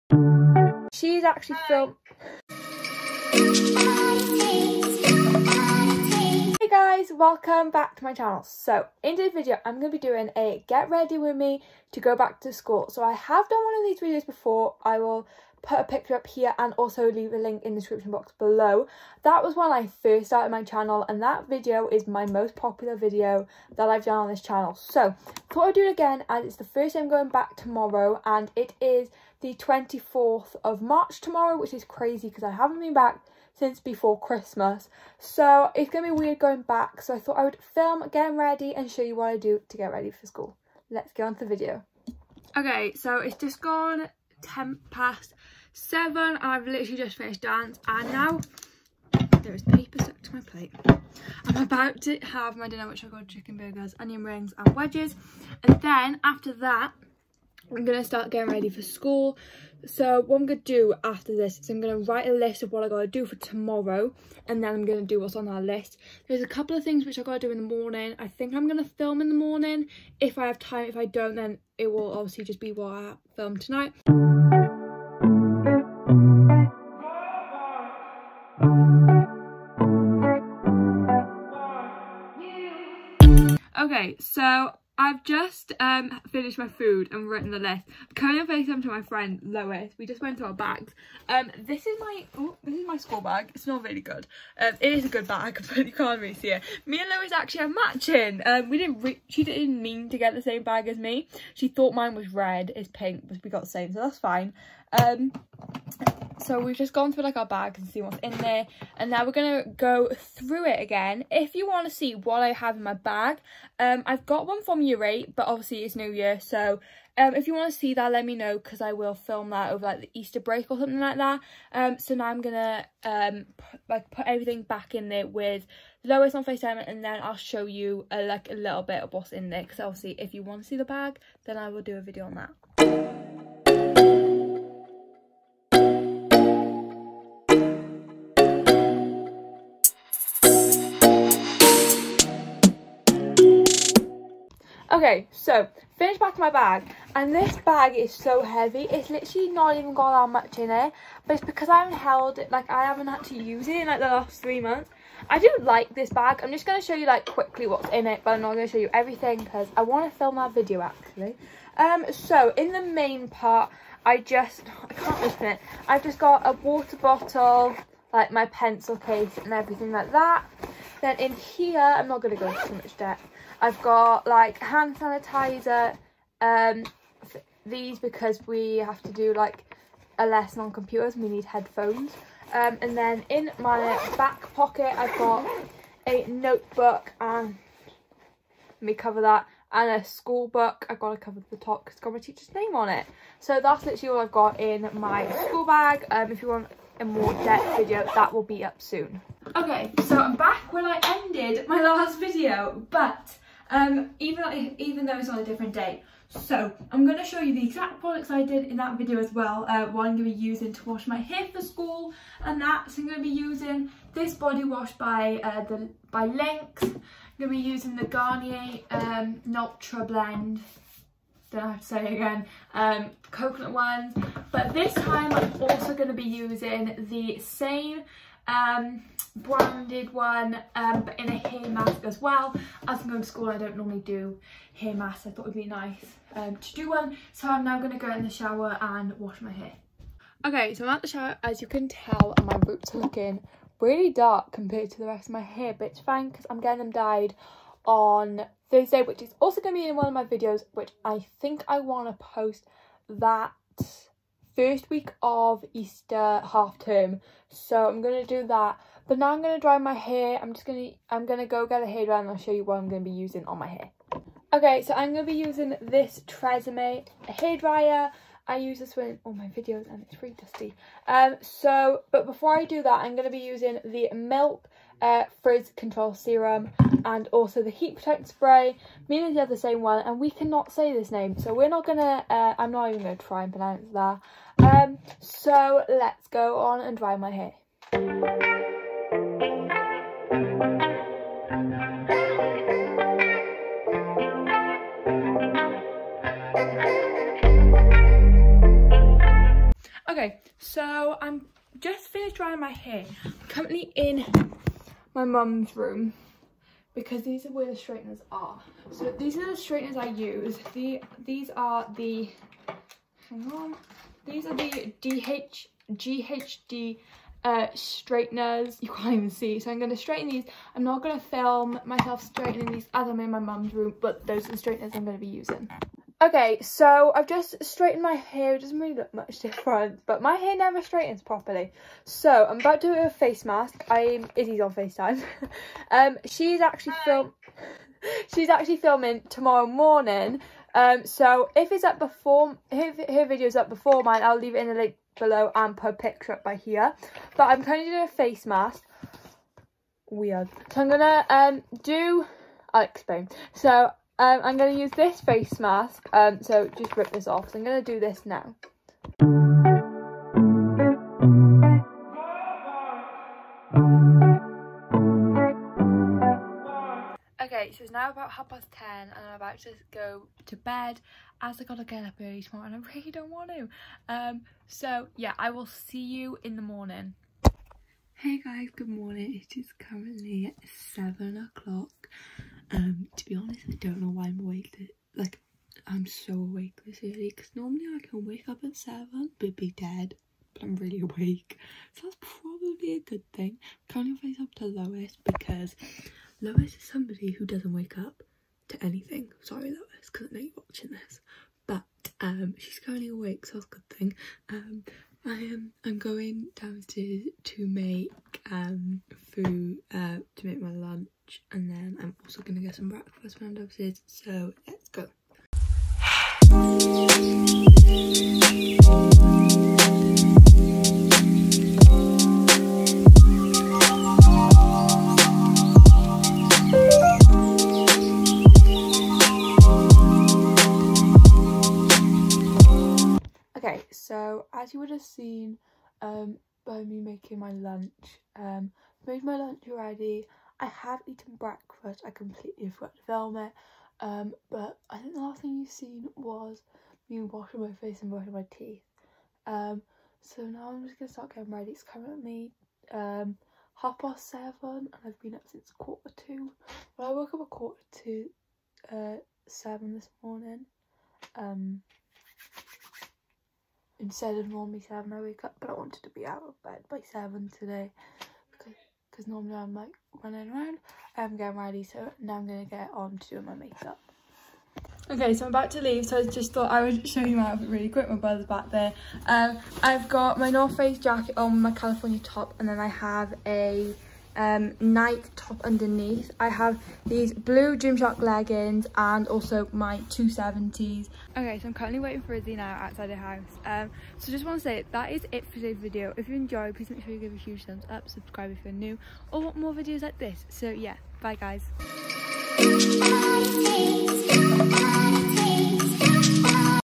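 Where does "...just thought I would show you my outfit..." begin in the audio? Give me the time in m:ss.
7:56.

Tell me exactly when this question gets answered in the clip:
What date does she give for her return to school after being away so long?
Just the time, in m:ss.
0:29.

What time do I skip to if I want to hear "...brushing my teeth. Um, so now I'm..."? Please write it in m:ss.
7:28.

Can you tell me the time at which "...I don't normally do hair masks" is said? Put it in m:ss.
3:53.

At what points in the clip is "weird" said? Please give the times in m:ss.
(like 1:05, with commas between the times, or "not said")
0:36, 5:50.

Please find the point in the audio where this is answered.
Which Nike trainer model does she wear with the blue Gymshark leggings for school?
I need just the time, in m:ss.
8:10.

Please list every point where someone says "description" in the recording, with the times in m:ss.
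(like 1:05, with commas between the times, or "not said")
0:17.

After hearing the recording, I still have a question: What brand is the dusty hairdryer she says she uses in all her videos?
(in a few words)
Tresemme.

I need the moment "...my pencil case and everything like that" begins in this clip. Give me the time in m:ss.
2:48.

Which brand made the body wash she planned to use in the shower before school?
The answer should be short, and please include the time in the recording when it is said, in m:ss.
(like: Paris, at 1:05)
Lynx, at 3:36.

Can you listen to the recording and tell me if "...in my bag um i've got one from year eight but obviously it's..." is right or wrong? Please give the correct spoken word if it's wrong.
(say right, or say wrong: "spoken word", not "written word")
right.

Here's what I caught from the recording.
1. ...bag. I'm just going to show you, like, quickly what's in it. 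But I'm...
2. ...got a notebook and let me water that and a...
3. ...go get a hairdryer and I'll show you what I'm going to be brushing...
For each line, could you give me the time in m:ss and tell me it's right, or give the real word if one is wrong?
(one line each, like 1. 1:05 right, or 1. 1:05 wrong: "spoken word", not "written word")
1. 2:36 right
2. 3:05 wrong: "cover", not "water"
3. 4:21 wrong: "using", not "brushing".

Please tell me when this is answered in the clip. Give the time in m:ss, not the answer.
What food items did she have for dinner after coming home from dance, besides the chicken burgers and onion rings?
0:54.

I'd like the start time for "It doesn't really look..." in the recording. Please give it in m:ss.
5:28.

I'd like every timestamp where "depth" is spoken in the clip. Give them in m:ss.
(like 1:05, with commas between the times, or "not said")
2:52, 3:17.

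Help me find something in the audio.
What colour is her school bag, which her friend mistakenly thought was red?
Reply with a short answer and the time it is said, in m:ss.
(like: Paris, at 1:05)
Pink, at 1:42.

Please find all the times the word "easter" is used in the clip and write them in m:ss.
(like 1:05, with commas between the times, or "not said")
2:00, 4:15.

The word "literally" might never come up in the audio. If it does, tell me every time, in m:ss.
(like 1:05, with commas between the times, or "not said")
0:46, 2:29, 3:13.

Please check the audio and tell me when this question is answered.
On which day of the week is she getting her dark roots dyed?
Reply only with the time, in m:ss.
4:08.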